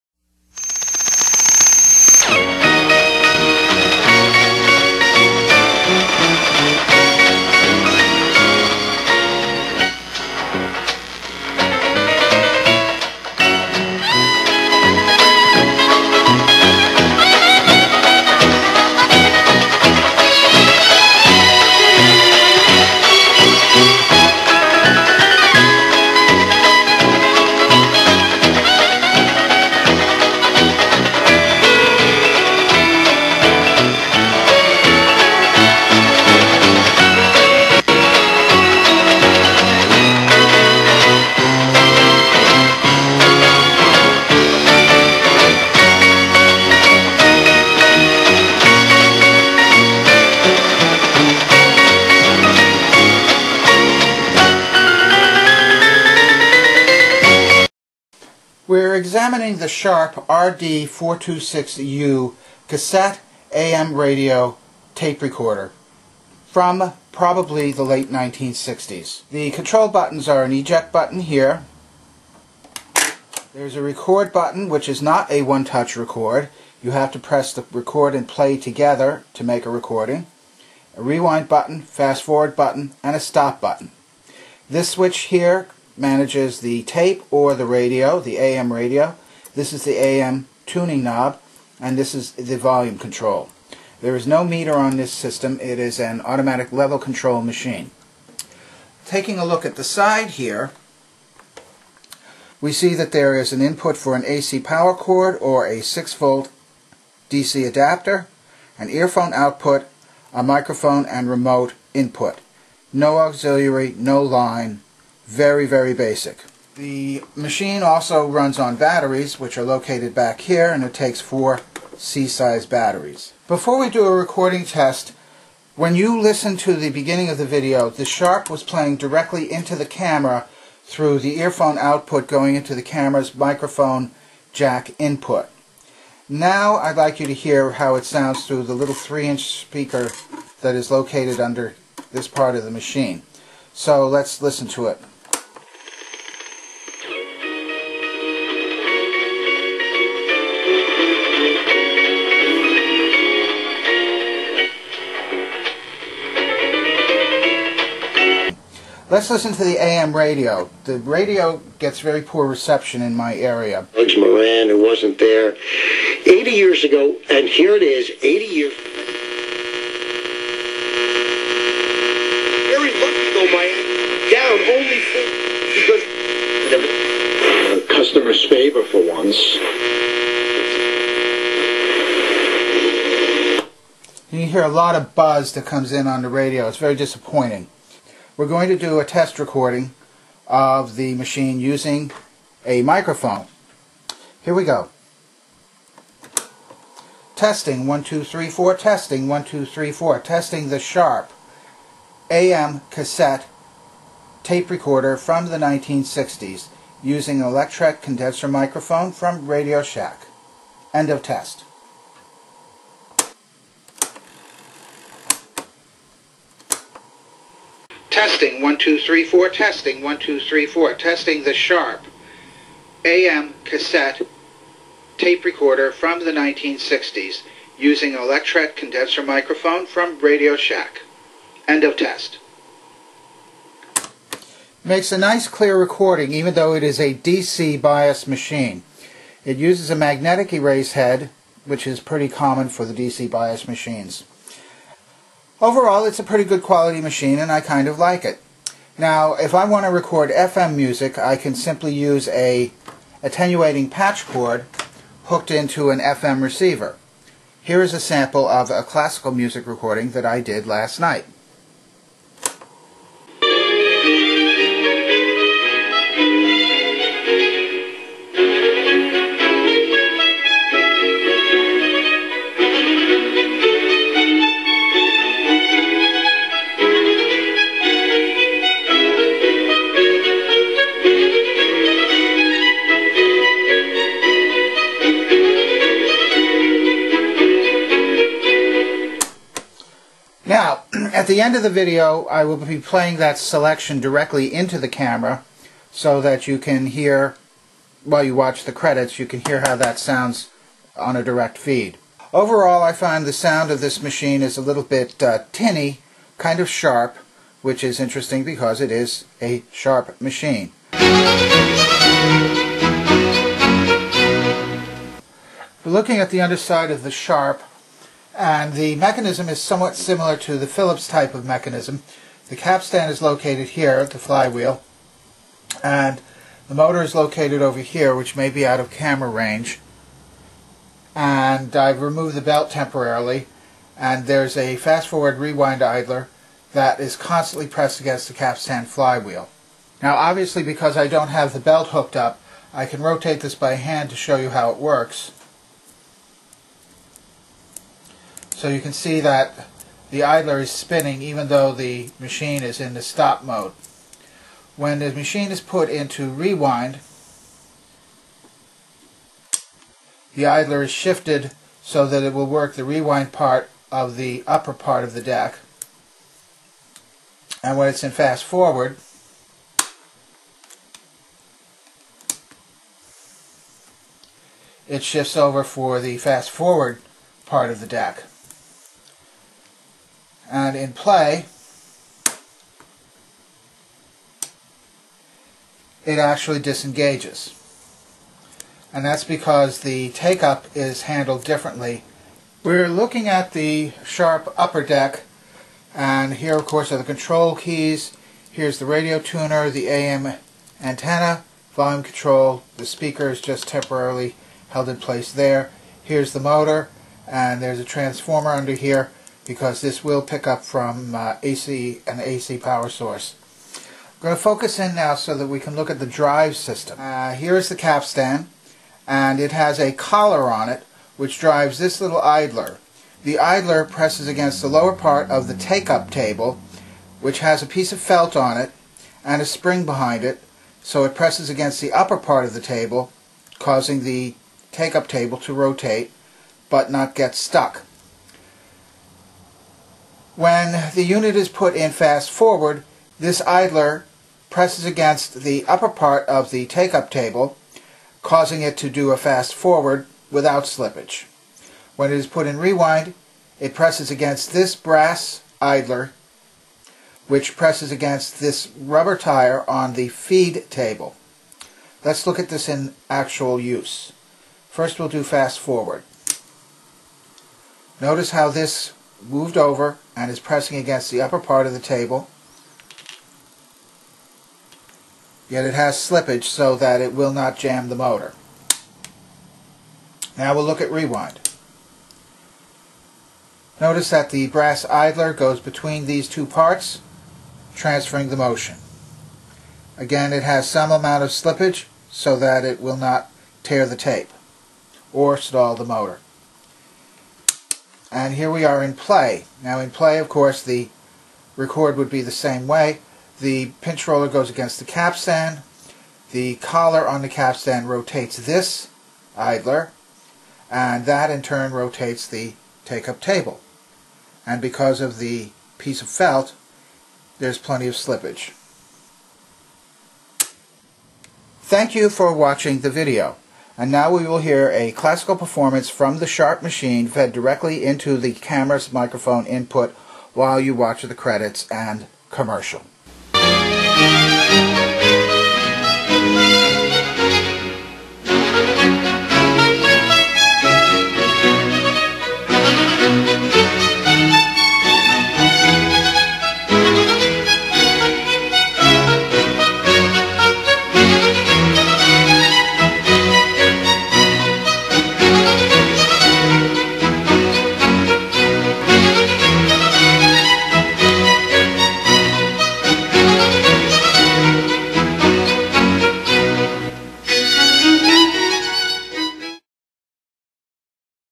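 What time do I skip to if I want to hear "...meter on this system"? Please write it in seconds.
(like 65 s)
94 s.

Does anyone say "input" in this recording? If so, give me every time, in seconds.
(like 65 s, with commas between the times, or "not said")
103 s, 111 s, 134 s, 529 s.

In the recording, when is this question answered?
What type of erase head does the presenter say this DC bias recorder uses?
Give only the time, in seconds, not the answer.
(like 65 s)
239 s.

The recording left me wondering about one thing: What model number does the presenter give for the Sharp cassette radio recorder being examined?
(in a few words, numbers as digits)
RD426U.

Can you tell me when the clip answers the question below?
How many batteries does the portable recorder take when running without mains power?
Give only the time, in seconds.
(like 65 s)
121 s.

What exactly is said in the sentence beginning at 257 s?
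Here is a sample of a classical music recording that I did last night.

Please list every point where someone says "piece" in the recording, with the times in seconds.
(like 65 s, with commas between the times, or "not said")
427 s, 515 s.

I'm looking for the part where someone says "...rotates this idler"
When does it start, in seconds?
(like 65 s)
507 s.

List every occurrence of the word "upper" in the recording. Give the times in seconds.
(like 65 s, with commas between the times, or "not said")
364 s, 394 s, 431 s, 445 s, 471 s.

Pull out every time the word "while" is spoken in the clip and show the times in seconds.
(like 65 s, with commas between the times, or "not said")
298 s, 530 s.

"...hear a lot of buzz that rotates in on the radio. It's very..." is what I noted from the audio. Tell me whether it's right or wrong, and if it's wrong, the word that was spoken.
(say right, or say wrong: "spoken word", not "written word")
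wrong: "comes", not "rotates".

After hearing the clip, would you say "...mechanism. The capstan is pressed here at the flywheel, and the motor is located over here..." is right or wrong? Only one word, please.
wrong.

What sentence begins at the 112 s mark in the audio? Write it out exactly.
No auxiliary, no line, very, very basic.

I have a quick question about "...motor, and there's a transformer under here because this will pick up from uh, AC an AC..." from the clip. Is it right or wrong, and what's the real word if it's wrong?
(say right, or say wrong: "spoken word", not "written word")
right.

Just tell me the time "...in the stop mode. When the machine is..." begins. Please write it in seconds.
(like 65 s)
352 s.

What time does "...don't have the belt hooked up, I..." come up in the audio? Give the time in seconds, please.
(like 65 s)
341 s.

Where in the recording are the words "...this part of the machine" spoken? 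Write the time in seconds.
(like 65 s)
142 s.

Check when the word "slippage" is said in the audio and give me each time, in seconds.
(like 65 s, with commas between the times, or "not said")
450 s, 475 s, 491 s, 517 s.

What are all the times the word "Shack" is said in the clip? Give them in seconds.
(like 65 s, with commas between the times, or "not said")
209 s, 230 s.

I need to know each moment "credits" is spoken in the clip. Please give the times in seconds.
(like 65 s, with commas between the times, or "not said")
298 s, 531 s.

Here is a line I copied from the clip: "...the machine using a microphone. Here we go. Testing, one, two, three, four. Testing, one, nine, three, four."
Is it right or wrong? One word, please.
wrong.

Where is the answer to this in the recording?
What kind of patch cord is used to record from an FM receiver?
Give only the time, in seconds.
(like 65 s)
253 s.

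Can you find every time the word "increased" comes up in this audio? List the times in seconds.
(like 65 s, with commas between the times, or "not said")
not said.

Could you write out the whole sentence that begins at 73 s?
There's a record button, which is not a one-touch record.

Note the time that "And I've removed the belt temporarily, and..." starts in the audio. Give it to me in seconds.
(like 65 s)
331 s.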